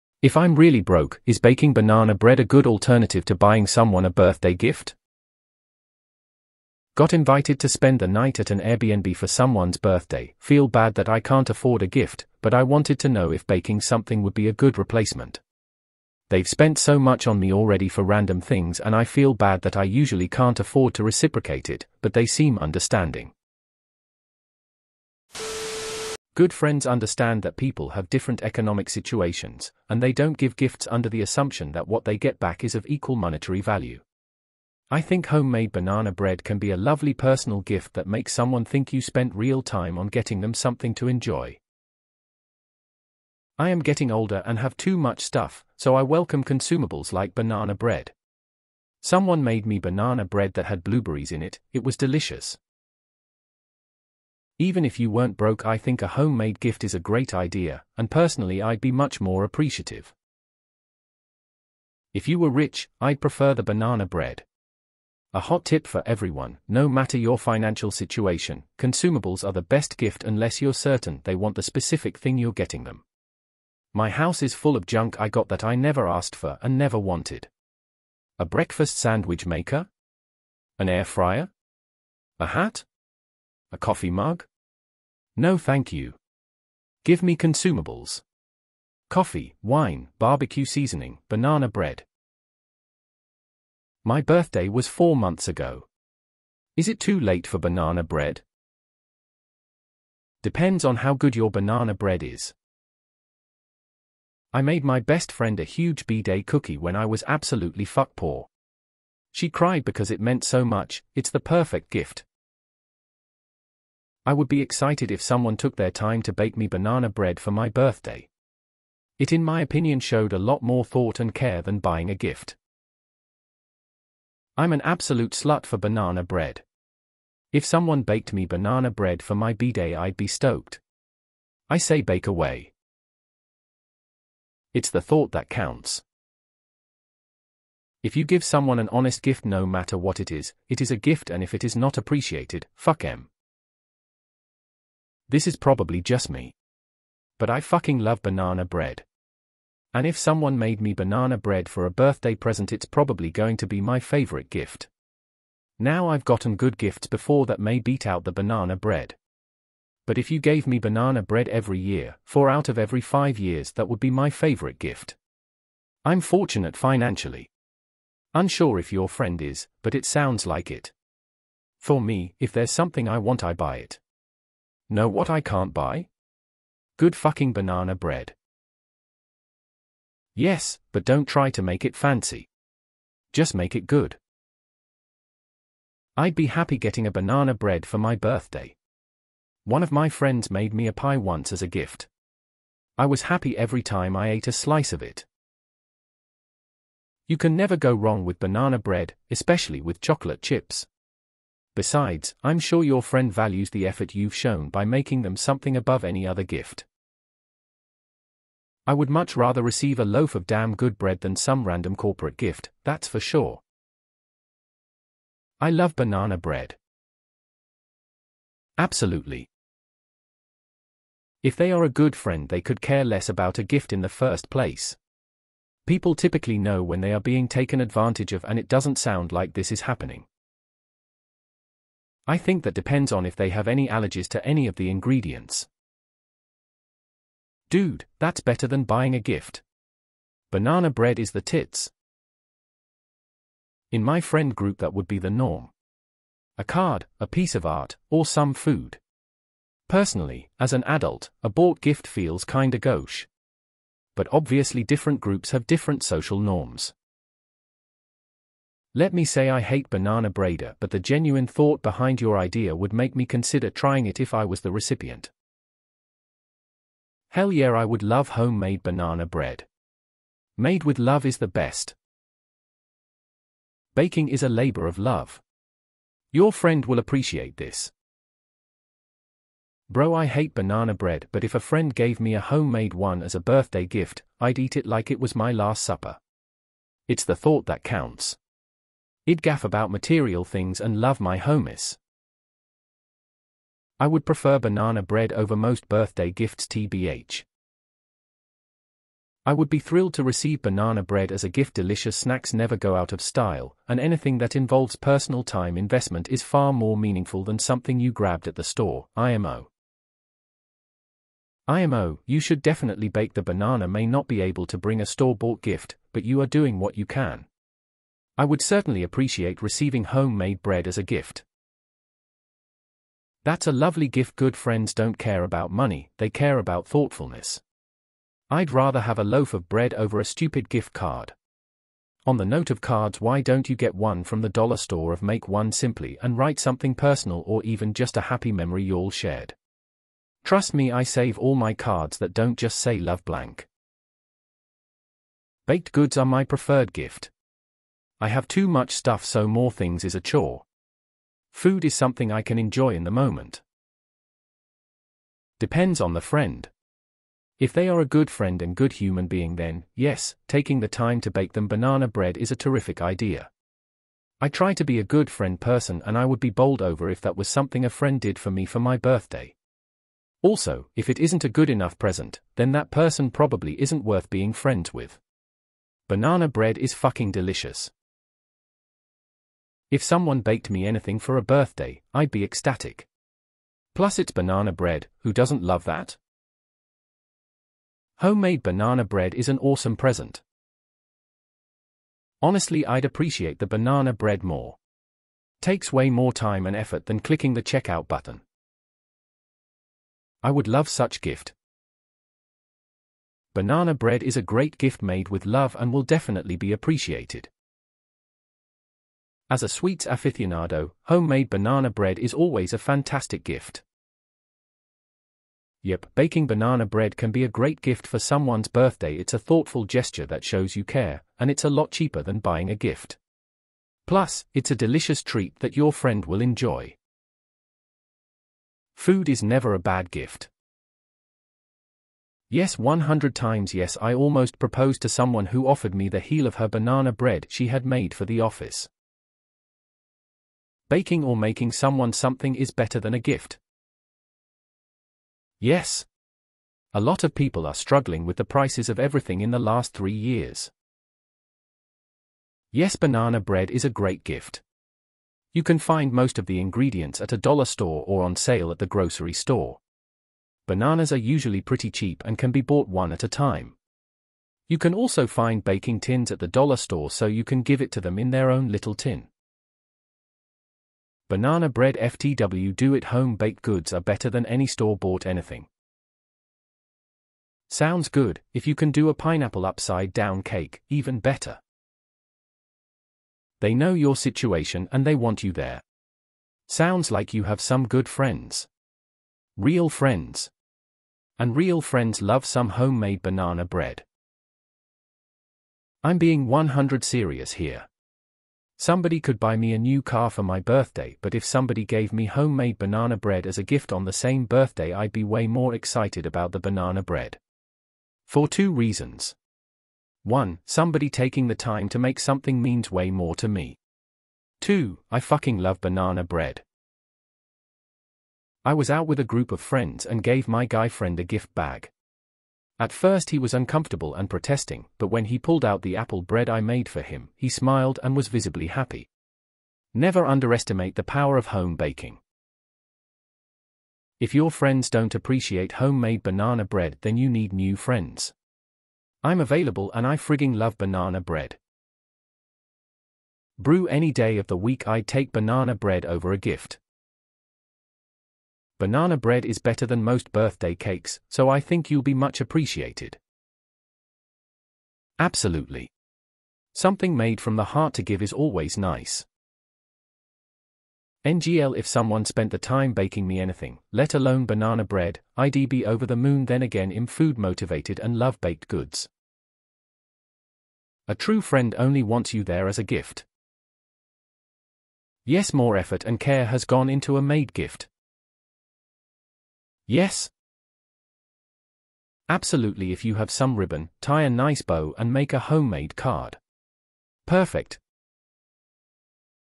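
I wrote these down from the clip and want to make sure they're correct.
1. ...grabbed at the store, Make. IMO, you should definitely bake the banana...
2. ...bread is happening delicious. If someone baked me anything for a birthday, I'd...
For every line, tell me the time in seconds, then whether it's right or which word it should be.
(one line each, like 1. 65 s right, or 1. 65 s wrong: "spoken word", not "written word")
1. 308 s wrong: "IMO", not "Make"
2. 376 s wrong: "fucking", not "happening".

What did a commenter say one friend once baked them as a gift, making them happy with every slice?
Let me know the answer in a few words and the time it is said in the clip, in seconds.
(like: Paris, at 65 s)
pie, at 190 s.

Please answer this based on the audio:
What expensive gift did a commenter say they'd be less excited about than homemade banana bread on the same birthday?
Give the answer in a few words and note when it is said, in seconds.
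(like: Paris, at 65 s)
new car, at 499 s.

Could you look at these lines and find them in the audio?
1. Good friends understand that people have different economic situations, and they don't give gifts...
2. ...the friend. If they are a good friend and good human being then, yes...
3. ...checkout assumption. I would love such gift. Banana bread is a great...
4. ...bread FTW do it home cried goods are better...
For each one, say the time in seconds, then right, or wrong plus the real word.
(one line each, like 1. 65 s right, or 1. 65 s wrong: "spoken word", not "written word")
1. 26 s right
2. 356 s right
3. 397 s wrong: "button", not "assumption"
4. 471 s wrong: "baked", not "cried".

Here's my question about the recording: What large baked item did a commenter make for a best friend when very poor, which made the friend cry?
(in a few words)
cookie.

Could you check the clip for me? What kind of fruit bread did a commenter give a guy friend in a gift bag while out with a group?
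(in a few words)
apple bread.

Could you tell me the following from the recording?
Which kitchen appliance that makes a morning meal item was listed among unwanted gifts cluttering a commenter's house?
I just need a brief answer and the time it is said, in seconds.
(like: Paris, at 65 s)
breakfast sandwich maker, at 78 s.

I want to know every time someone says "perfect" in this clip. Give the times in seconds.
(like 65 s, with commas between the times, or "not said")
111 s, 587 s.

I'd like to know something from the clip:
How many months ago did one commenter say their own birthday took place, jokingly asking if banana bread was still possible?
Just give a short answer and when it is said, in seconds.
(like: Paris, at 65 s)
4, at 94 s.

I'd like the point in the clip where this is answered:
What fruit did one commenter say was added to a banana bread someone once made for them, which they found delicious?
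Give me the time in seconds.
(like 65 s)
50 s.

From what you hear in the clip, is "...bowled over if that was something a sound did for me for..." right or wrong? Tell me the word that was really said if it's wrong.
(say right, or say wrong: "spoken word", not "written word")
wrong: "friend", not "sound".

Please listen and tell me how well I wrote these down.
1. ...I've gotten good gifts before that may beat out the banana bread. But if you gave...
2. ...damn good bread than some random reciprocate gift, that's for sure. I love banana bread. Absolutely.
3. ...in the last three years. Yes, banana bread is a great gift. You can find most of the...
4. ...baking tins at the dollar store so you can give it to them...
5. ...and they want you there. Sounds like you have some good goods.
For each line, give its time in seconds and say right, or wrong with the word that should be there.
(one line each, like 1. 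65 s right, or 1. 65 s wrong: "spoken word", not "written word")
1. 156 s right
2. 210 s wrong: "corporate", not "reciprocate"
3. 449 s right
4. 465 s right
5. 484 s wrong: "friends", not "goods".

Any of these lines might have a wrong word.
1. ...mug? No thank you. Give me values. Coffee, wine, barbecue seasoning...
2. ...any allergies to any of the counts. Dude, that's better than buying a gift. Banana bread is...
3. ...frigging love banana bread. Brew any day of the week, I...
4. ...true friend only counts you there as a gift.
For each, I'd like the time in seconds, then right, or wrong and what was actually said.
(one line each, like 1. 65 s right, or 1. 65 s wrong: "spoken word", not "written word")
1. 84 s wrong: "consumables", not "values"
2. 233 s wrong: "ingredients", not "counts"
3. 540 s right
4. 571 s wrong: "wants", not "counts".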